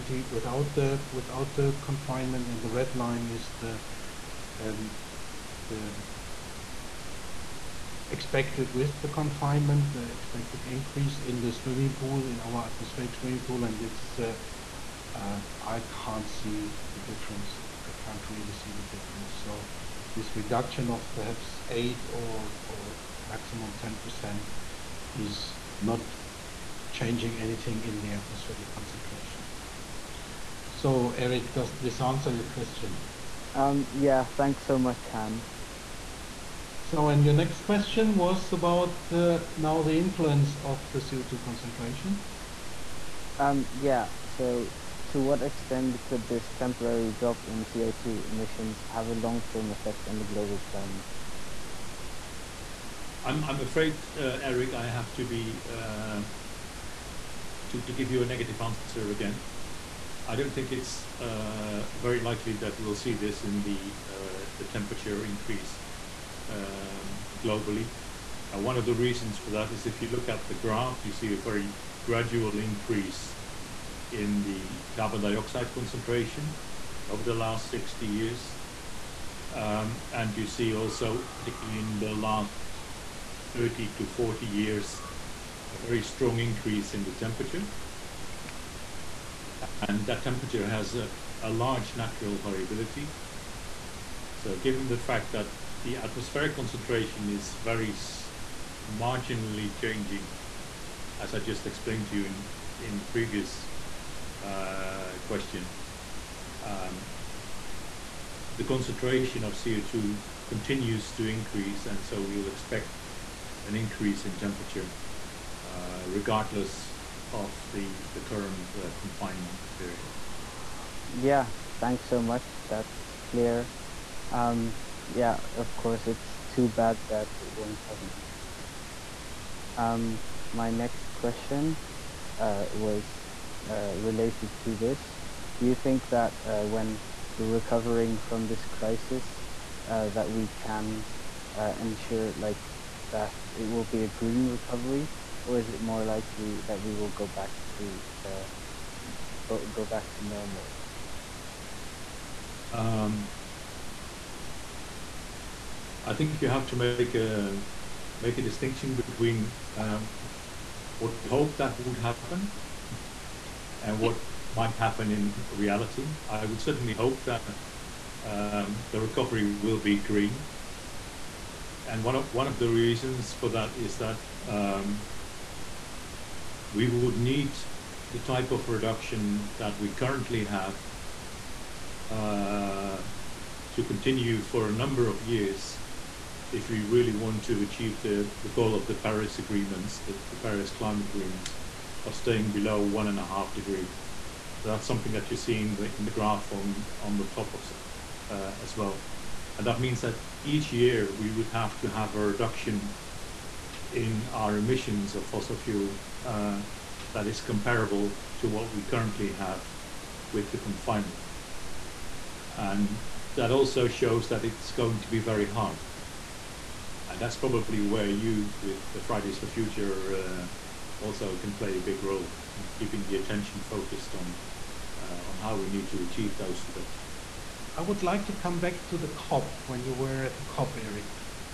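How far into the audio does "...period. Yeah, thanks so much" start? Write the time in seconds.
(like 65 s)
119 s.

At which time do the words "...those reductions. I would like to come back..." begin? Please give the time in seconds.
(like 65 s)
226 s.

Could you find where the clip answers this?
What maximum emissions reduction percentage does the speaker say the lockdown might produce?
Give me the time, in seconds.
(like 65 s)
23 s.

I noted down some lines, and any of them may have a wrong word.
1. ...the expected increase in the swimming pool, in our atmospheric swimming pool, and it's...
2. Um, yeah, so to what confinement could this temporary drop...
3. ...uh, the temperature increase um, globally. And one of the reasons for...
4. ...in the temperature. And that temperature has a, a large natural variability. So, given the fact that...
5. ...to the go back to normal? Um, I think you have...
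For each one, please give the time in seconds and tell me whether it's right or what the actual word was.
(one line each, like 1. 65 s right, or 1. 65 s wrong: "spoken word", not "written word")
1. 9 s right
2. 43 s wrong: "extent", not "confinement"
3. 64 s right
4. 86 s right
5. 147 s right.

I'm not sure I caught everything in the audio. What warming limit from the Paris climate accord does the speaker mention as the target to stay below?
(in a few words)
1.5 degrees.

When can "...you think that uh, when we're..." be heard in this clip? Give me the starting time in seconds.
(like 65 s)
135 s.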